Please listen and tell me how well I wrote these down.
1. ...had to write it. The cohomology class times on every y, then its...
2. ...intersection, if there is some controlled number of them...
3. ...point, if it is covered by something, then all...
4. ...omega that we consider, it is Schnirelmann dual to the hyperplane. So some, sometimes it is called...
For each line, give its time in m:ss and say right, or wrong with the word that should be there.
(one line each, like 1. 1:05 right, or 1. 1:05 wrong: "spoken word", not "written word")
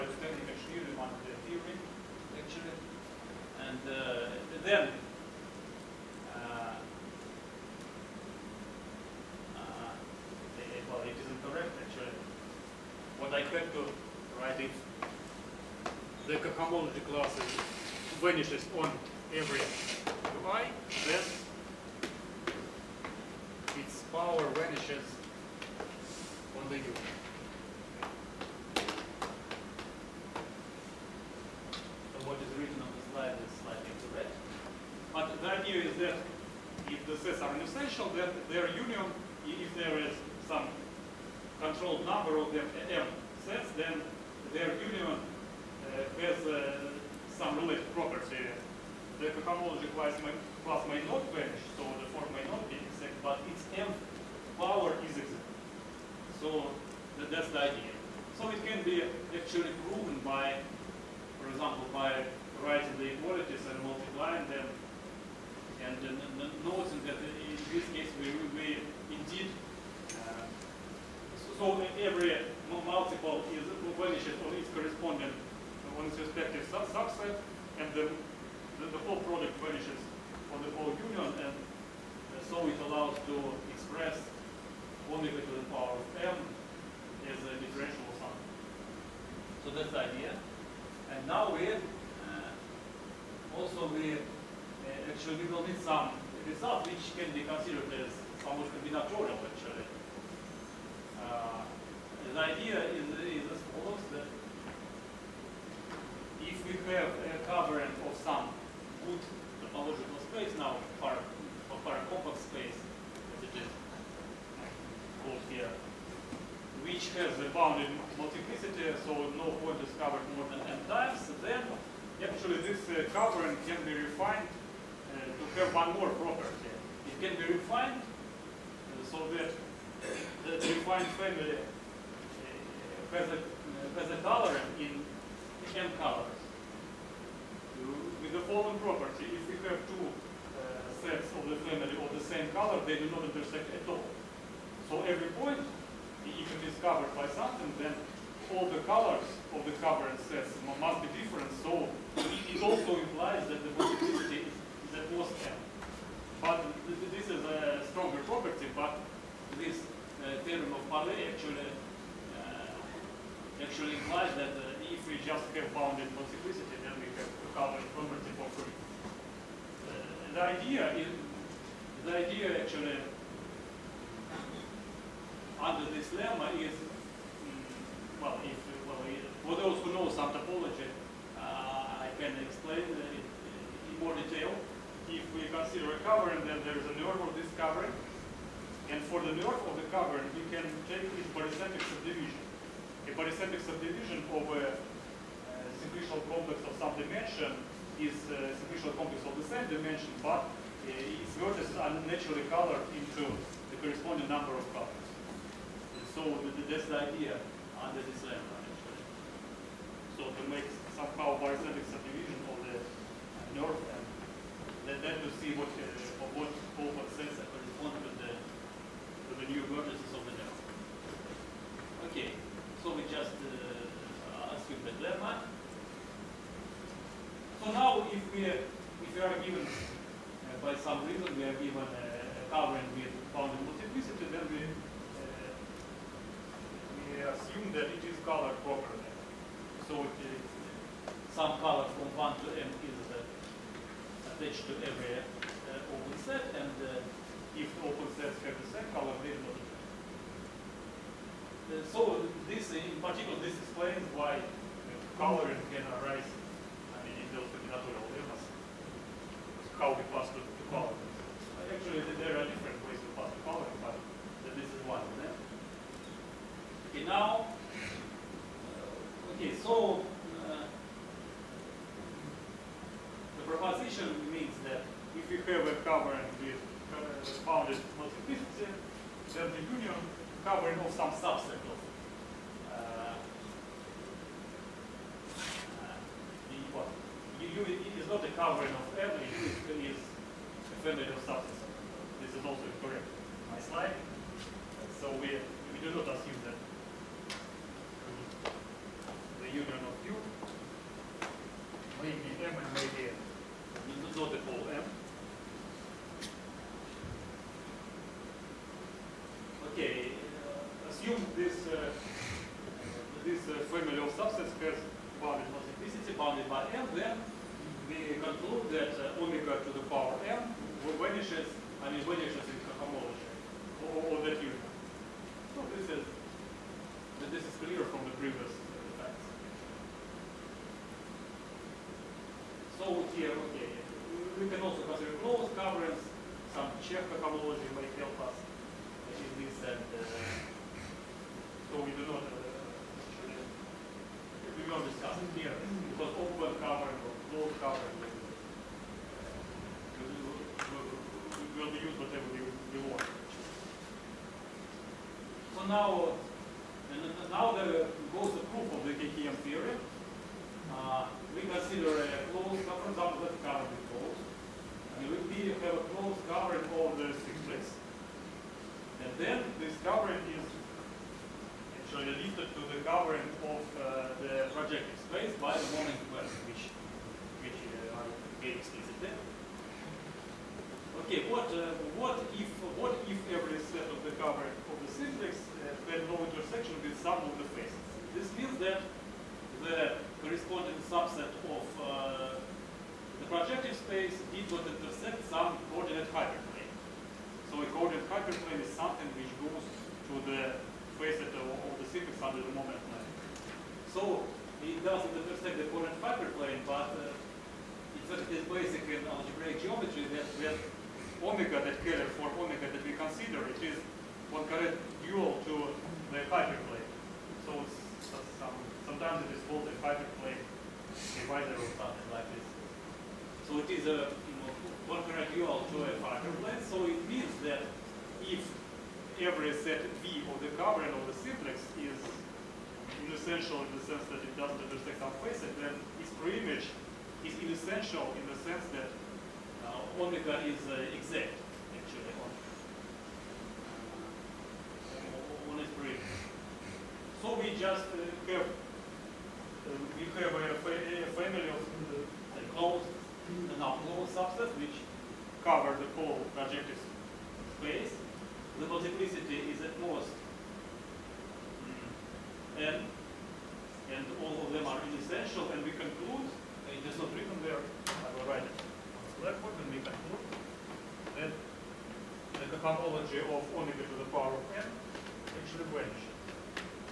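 1. 0:13 wrong: "vanishes", not "times"
2. 0:38 wrong: "union", not "intersection"
3. 2:25 right
4. 6:52 wrong: "Poincaré", not "Schnirelmann".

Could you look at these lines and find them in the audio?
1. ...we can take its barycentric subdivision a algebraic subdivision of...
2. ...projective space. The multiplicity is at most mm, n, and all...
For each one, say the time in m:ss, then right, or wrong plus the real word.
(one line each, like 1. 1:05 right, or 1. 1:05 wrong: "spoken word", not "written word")
1. 3:10 wrong: "barycentric", not "algebraic"
2. 7:36 right.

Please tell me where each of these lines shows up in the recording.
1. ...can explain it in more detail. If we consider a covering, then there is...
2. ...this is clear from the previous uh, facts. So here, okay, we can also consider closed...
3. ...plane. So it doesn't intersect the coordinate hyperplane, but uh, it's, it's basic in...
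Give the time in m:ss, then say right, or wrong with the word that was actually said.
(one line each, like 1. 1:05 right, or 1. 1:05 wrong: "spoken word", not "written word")
1. 3:02 right
2. 5:27 right
3. 6:42 right.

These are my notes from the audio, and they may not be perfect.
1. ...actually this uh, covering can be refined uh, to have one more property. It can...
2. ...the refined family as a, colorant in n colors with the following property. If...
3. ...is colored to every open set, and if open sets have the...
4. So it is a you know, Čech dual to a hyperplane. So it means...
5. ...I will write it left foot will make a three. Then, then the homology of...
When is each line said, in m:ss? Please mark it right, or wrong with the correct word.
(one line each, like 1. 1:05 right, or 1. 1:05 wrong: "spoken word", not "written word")
1. 2:02 right
2. 2:10 right
3. 4:02 wrong: "attached", not "colored"
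4. 7:03 wrong: "Poincaré", not "Čech"
5. 7:47 wrong: "two", not "three".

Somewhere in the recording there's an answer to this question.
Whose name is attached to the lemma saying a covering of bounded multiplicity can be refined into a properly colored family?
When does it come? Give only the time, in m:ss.
2:40.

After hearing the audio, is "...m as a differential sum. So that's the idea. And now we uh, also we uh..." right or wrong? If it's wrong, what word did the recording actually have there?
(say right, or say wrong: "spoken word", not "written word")
right.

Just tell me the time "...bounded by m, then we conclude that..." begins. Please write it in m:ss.
5:16.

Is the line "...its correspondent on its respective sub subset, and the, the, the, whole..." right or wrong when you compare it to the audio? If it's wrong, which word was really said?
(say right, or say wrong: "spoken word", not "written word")
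right.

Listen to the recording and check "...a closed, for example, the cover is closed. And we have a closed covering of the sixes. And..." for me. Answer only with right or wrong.
right.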